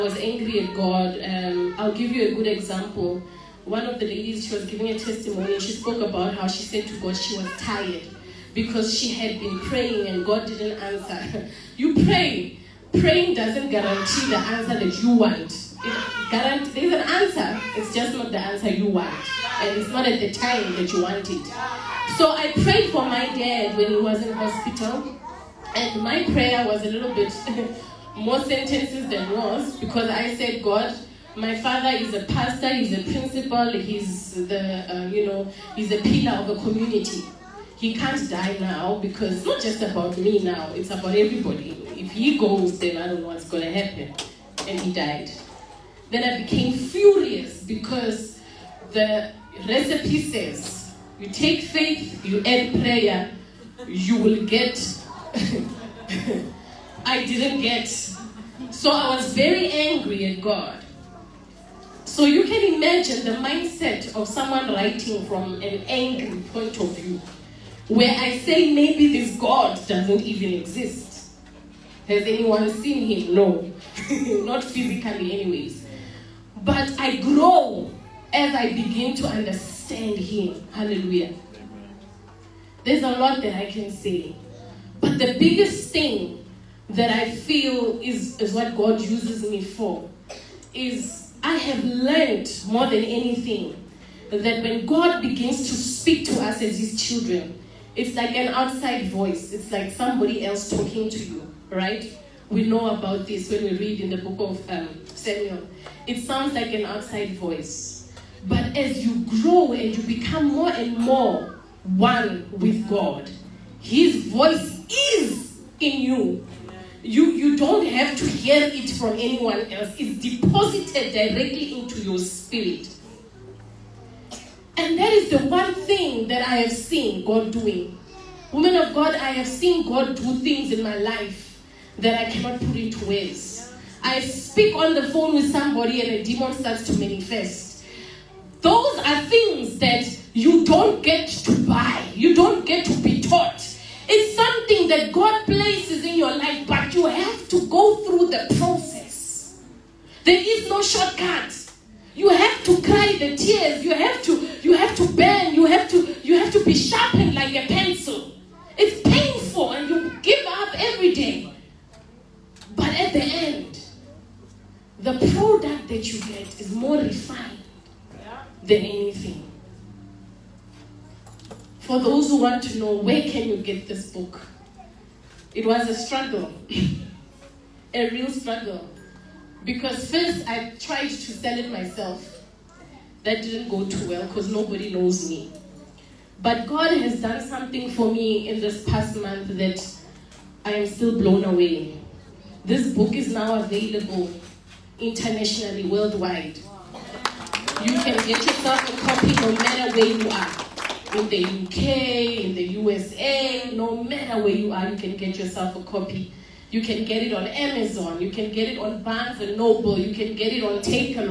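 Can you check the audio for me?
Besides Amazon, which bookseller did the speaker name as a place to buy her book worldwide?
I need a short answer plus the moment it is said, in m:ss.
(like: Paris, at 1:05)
Barnes and Noble, at 3:29.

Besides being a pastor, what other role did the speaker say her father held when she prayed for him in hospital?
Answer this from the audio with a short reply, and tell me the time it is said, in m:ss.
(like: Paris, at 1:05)
Principal, at 0:32.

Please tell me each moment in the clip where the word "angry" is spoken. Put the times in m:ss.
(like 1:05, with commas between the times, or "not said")
0:00, 0:59, 1:05.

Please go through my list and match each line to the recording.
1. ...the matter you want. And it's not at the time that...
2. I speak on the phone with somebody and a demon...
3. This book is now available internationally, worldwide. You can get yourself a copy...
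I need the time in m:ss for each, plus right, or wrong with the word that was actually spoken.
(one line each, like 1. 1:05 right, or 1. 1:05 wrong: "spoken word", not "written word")
1. 0:18 wrong: "answer", not "matter"
2. 2:14 right
3. 3:12 right.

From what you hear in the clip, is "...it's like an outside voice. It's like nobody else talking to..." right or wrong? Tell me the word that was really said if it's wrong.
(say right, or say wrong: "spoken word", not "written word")
wrong: "somebody", not "nobody".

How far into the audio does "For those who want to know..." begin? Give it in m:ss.
2:51.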